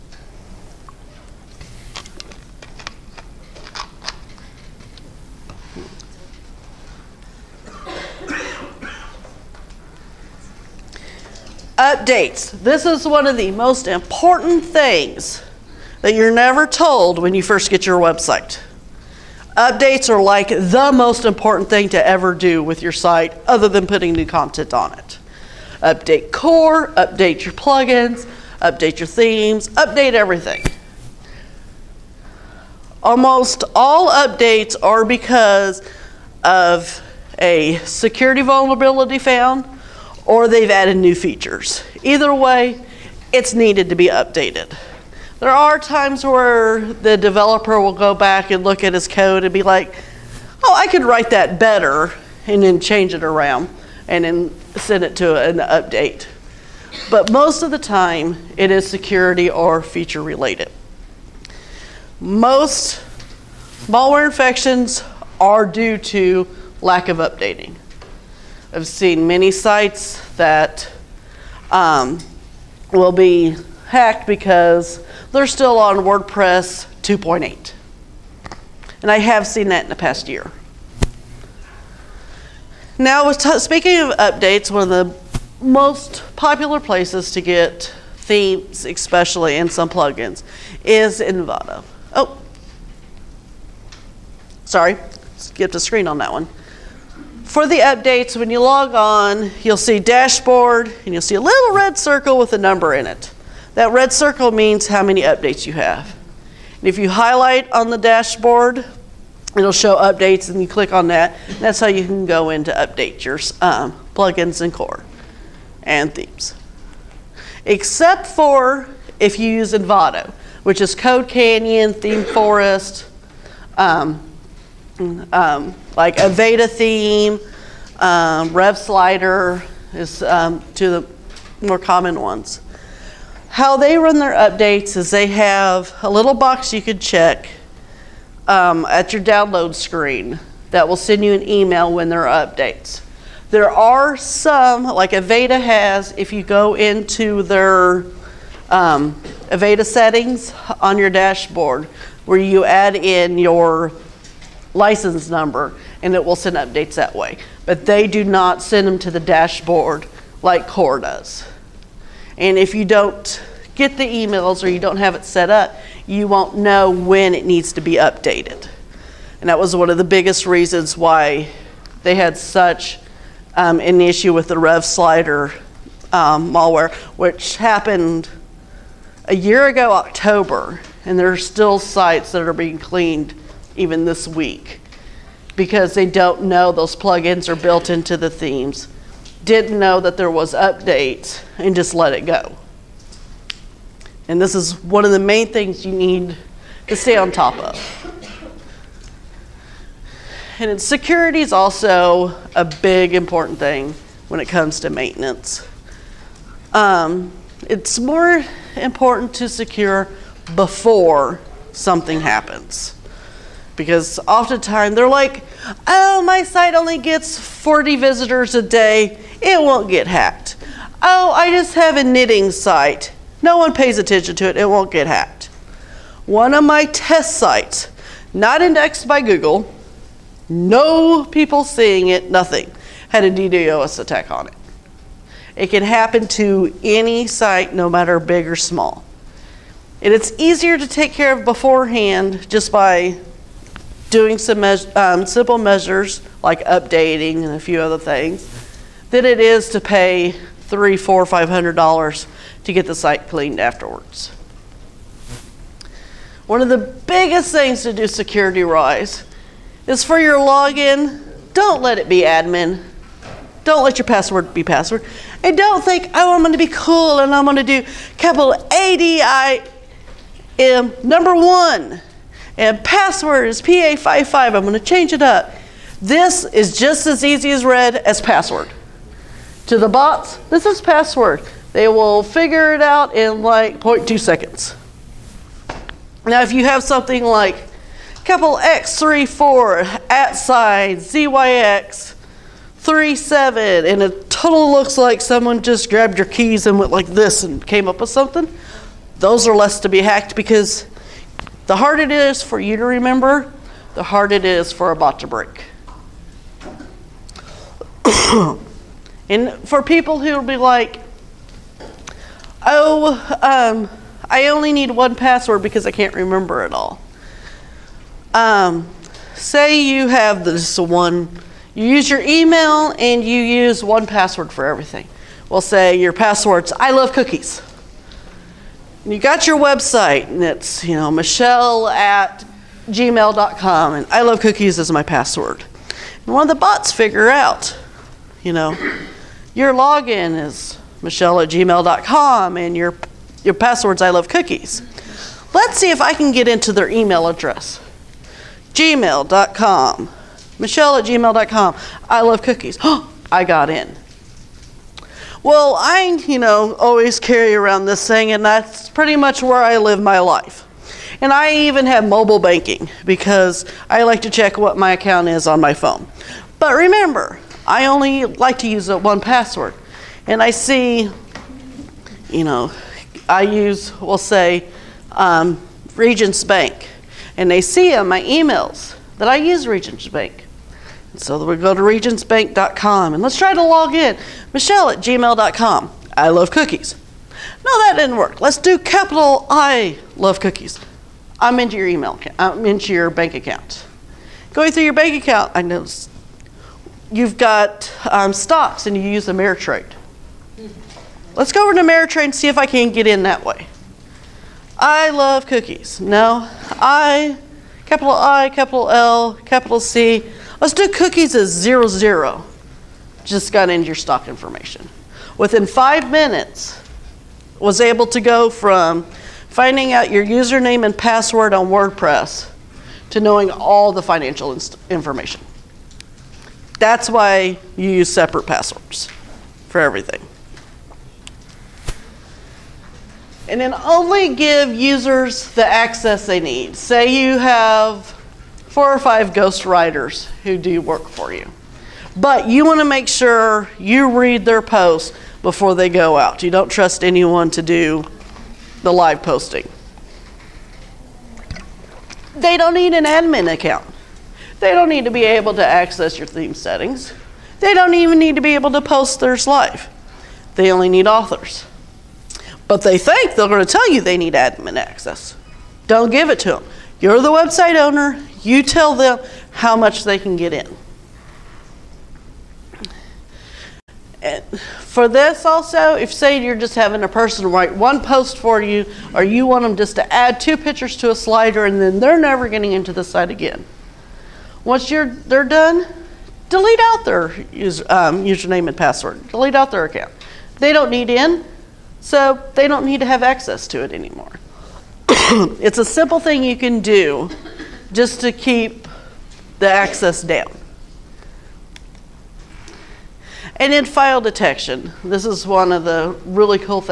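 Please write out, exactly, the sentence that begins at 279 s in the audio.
To the bots, this is password.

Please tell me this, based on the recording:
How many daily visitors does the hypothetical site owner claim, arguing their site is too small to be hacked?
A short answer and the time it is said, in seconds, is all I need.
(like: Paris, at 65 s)
40, at 217 s.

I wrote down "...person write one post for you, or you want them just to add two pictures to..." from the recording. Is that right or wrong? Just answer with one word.
right.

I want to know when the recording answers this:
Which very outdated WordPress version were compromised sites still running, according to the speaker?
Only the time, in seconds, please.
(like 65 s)
75 s.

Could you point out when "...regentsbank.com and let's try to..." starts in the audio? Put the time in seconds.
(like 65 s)
381 s.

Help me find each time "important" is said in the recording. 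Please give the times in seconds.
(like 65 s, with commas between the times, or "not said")
13 s, 21 s, 203 s, 208 s.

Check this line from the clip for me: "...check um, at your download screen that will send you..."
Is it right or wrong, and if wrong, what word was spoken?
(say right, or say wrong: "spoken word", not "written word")
right.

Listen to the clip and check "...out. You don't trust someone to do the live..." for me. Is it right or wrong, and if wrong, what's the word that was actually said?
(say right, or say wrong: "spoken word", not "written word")
wrong: "anyone", not "someone".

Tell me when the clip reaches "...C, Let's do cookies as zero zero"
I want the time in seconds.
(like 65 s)
409 s.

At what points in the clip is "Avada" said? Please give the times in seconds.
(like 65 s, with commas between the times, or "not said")
126 s, 145 s, 149 s.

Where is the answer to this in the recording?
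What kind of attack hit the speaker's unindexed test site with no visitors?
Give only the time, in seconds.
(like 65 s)
233 s.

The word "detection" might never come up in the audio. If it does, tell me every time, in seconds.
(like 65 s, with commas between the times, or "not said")
504 s.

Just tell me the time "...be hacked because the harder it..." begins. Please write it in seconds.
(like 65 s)
299 s.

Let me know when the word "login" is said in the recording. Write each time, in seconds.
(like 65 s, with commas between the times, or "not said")
260 s, 339 s.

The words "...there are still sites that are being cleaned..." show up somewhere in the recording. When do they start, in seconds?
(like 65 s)
181 s.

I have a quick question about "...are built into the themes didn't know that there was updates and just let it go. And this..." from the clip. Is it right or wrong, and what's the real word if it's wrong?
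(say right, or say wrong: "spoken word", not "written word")
right.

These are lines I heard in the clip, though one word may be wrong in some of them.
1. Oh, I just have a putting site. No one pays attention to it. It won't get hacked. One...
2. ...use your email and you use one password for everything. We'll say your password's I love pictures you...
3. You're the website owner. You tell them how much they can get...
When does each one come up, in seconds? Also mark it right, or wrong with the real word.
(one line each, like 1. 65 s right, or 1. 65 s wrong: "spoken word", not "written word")
1. 221 s wrong: "knitting", not "putting"
2. 321 s wrong: "cookies", not "pictures"
3. 467 s right.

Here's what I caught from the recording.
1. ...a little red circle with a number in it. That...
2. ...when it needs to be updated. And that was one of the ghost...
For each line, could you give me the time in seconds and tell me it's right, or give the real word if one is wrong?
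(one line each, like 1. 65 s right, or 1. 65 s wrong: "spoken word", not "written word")
1. 101 s right
2. 166 s wrong: "biggest", not "ghost".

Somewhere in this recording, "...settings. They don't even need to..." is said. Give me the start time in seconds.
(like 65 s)
456 s.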